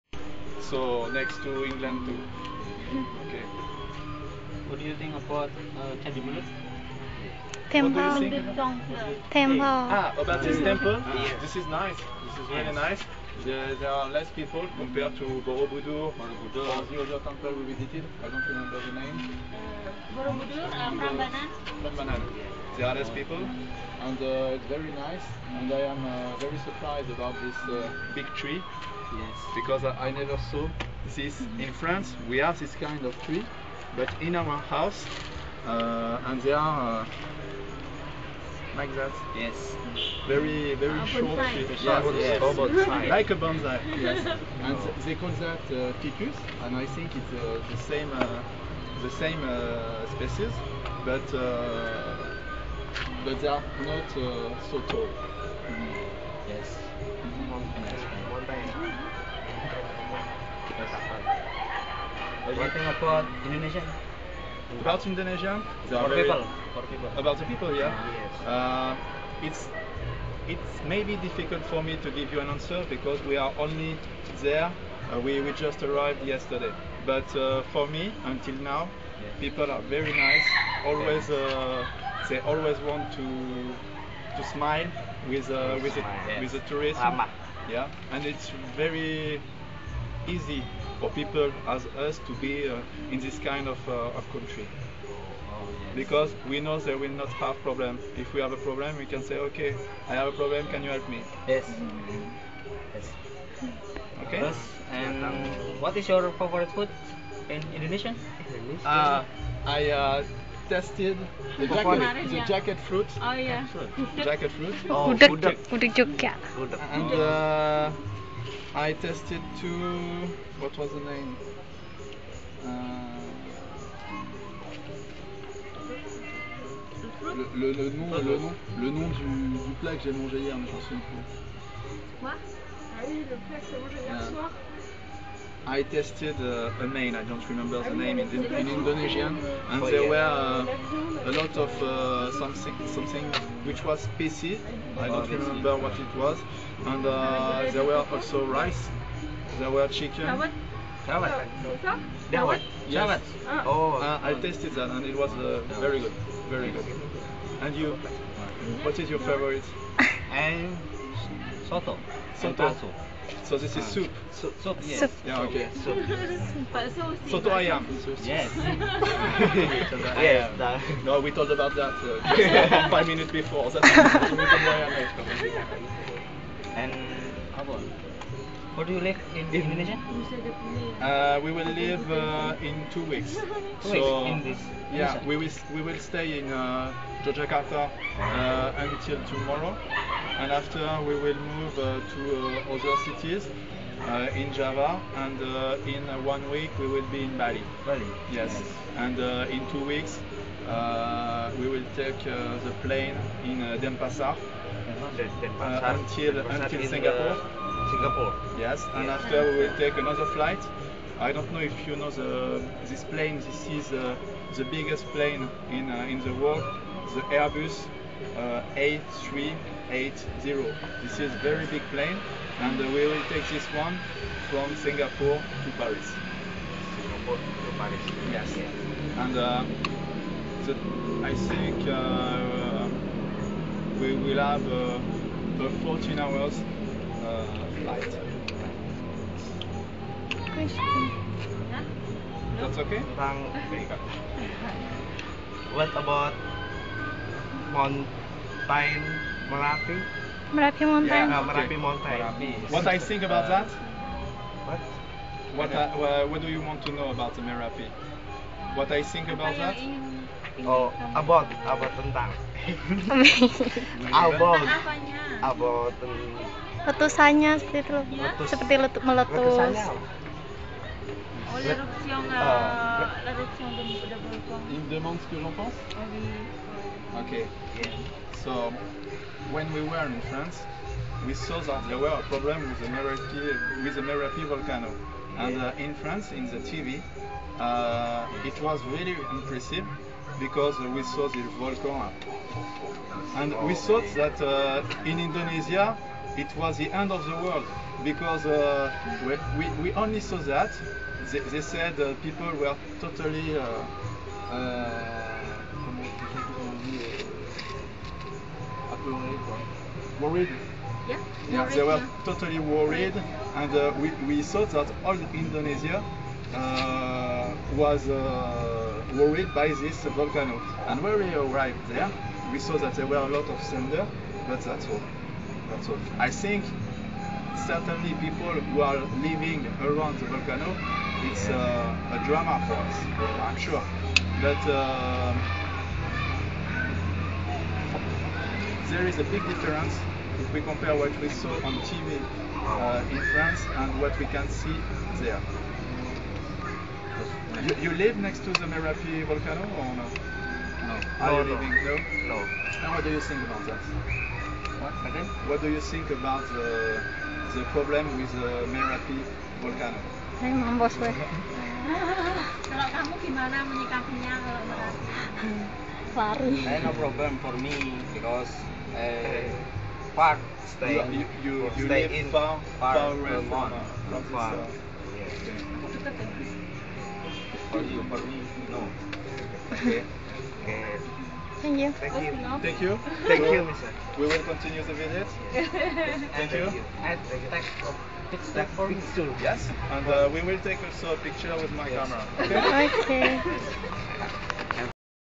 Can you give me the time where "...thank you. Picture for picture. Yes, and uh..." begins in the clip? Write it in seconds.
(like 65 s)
387 s.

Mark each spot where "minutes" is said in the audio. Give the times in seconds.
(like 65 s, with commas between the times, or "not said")
173 s.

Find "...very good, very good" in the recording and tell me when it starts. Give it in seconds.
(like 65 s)
155 s.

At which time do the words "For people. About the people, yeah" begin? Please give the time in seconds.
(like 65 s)
66 s.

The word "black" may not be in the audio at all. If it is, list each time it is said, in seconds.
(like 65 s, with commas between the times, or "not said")
not said.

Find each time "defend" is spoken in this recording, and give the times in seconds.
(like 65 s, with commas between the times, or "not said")
not said.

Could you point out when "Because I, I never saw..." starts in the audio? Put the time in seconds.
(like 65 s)
29 s.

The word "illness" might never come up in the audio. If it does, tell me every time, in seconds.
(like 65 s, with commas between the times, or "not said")
not said.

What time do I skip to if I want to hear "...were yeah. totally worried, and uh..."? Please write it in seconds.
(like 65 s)
311 s.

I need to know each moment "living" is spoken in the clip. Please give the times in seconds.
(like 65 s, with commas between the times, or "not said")
329 s, 351 s.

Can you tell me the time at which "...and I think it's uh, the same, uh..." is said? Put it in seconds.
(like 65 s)
46 s.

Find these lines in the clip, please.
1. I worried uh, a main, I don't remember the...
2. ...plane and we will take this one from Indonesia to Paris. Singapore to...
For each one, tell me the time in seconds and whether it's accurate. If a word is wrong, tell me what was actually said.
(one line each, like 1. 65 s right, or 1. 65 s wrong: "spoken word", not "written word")
1. 135 s wrong: "tested", not "worried"
2. 221 s wrong: "Singapore", not "Indonesia".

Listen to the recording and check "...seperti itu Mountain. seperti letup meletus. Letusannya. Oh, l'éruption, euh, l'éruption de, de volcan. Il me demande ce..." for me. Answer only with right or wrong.
wrong.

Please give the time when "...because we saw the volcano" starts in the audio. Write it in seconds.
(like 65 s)
290 s.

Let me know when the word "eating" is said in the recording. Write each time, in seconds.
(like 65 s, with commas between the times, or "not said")
not said.